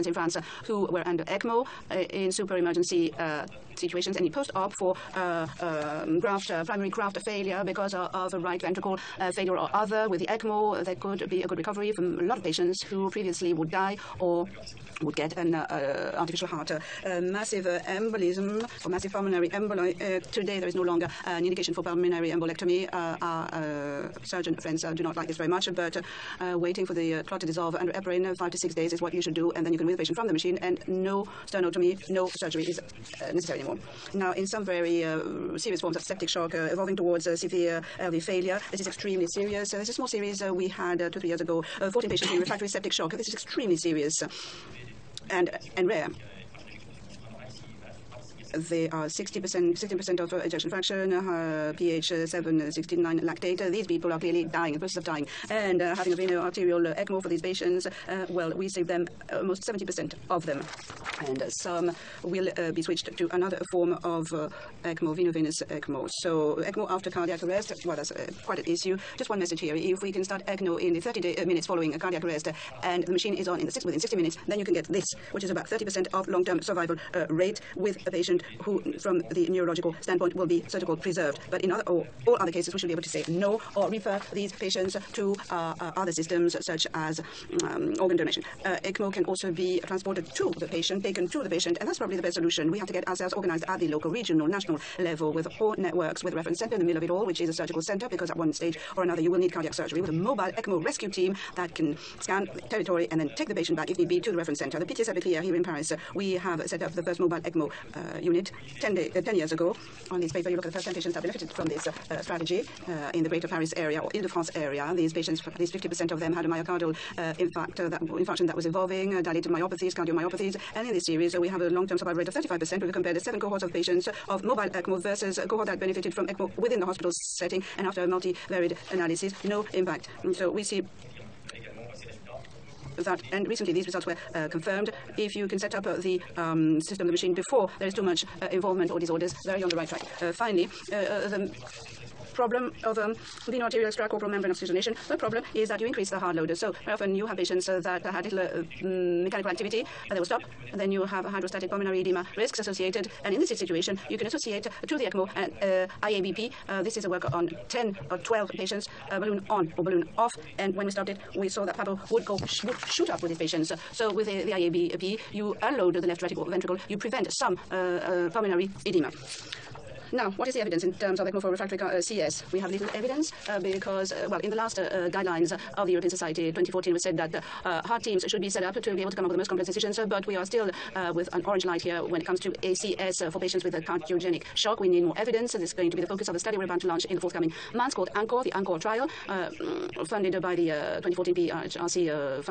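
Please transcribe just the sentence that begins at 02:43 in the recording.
So with the, the IABP, you unload the left ventricle, you prevent some uh, uh, pulmonary edema.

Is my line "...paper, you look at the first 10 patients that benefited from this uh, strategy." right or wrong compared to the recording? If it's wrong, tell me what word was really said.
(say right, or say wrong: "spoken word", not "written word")
right.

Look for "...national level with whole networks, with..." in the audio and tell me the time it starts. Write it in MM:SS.
01:34.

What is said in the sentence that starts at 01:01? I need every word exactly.
And some will uh, be switched to another form of uh, ECMO, veno-venous ECMO.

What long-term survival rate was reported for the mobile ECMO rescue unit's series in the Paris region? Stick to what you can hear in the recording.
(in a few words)
35%.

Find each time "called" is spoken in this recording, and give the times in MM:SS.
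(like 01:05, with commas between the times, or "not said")
01:20, 03:07.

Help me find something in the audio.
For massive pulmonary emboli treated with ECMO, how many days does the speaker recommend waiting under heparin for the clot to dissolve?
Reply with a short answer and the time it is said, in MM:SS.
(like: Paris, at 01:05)
5 to 6 days, at 00:28.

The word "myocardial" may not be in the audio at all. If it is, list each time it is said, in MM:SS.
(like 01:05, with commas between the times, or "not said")
01:56.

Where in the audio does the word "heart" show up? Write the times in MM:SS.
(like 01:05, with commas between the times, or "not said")
00:16, 02:57.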